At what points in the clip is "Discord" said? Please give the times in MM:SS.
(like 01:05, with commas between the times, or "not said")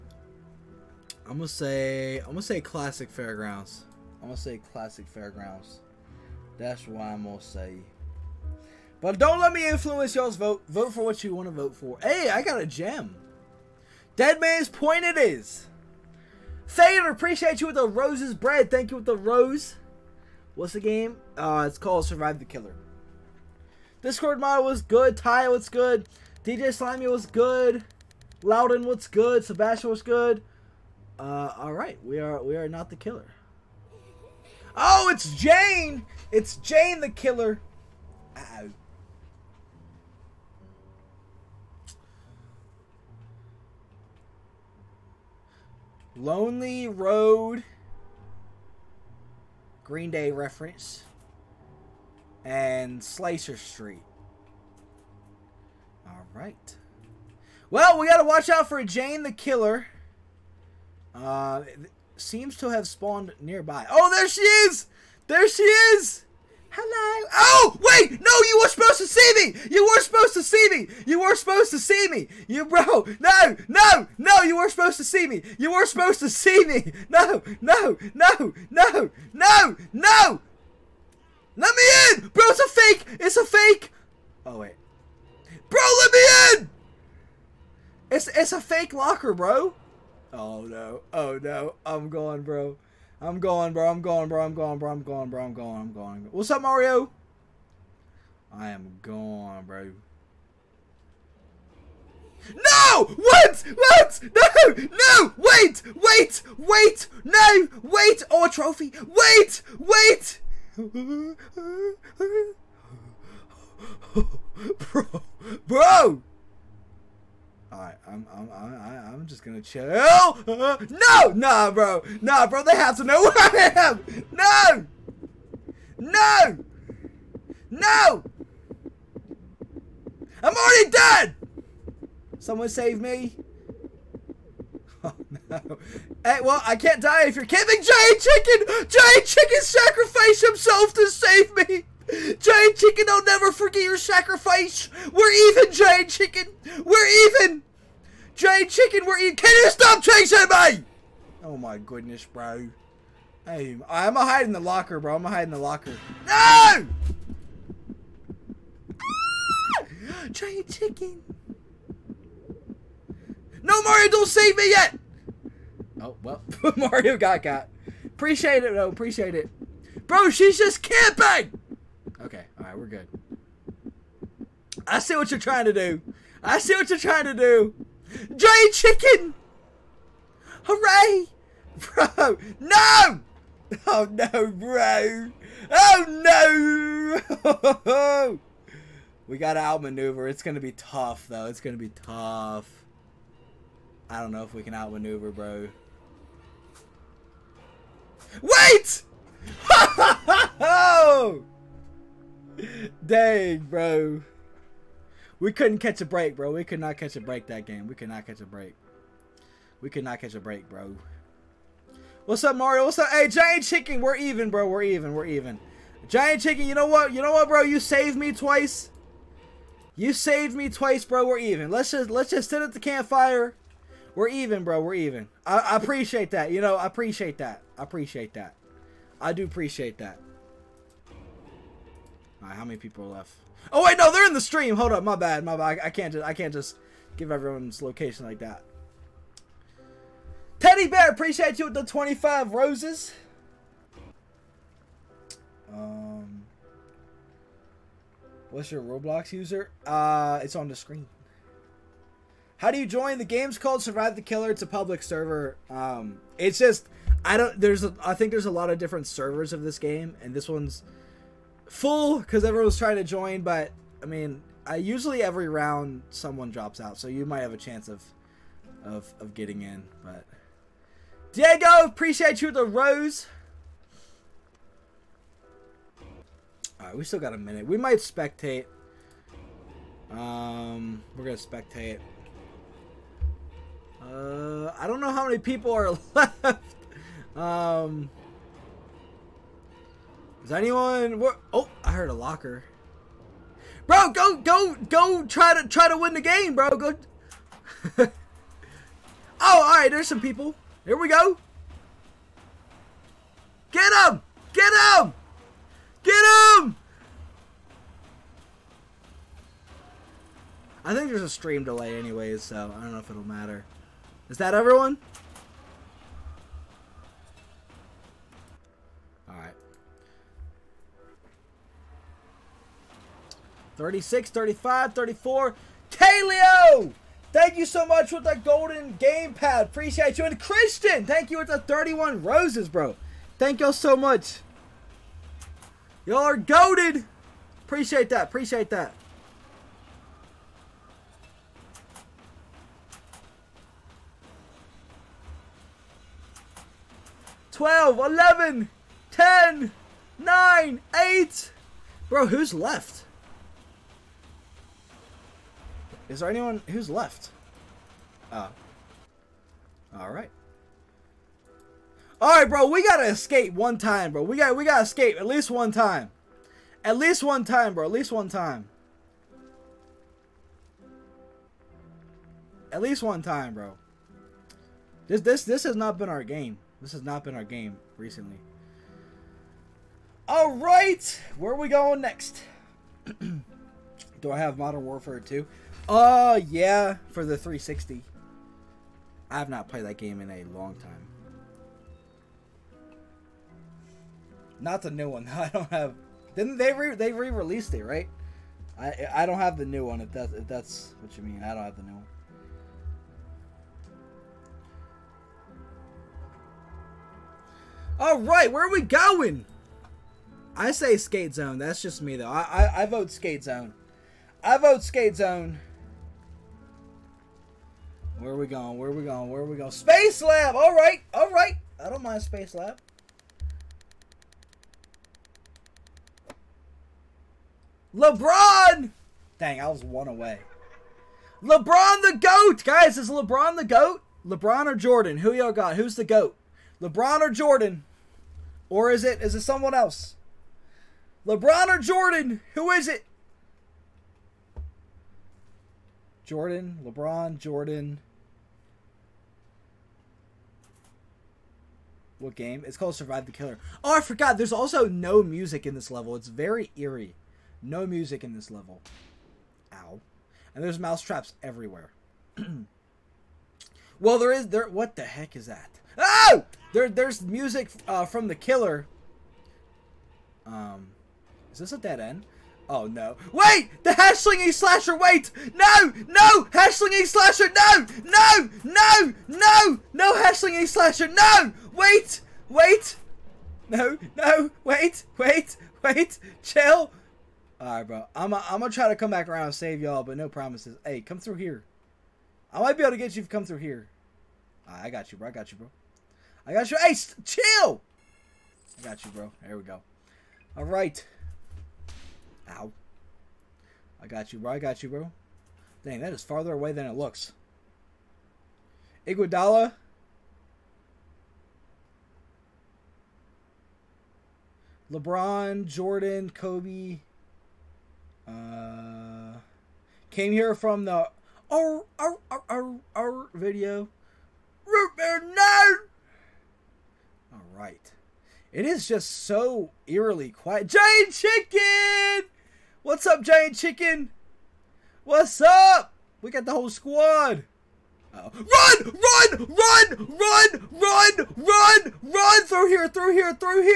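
00:24.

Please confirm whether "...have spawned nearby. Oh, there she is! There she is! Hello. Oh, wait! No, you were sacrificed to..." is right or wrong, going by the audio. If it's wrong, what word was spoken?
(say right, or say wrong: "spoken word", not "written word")
wrong: "supposed", not "sacrificed".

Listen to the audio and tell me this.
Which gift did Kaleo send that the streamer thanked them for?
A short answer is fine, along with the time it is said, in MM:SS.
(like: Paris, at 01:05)
Golden gamepad, at 05:28.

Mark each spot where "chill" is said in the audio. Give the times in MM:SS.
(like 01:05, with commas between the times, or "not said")
01:59, 08:06, 08:17.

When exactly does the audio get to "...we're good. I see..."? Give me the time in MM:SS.
02:52.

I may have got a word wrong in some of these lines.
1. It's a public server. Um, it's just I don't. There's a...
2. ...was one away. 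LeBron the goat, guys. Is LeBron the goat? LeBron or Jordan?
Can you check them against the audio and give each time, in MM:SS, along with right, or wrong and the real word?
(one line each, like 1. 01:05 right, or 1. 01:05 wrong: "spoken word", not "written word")
1. 04:14 right
2. 07:09 right.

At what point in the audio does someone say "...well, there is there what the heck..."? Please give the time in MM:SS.
07:43.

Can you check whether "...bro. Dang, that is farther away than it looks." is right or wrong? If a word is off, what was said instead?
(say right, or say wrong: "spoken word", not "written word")
right.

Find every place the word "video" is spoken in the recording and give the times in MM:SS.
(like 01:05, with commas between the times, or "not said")
08:43.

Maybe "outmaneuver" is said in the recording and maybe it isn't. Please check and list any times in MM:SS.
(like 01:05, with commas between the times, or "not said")
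03:09, 03:14.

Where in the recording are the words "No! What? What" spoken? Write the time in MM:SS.
01:42.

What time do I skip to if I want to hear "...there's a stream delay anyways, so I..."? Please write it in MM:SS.
05:11.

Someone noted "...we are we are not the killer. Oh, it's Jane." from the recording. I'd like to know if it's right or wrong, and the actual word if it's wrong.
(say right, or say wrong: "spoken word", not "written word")
right.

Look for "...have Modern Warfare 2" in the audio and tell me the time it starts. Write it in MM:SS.
06:24.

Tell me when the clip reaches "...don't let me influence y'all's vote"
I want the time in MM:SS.
00:09.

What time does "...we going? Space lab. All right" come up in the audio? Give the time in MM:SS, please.
06:59.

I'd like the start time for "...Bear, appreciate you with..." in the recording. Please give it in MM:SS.
04:00.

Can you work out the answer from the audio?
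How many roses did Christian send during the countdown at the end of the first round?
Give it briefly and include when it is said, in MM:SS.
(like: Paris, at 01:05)
31, at 05:31.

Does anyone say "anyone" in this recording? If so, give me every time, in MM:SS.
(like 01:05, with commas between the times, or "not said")
04:50, 05:56.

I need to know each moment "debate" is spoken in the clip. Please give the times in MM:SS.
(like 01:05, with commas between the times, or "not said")
not said.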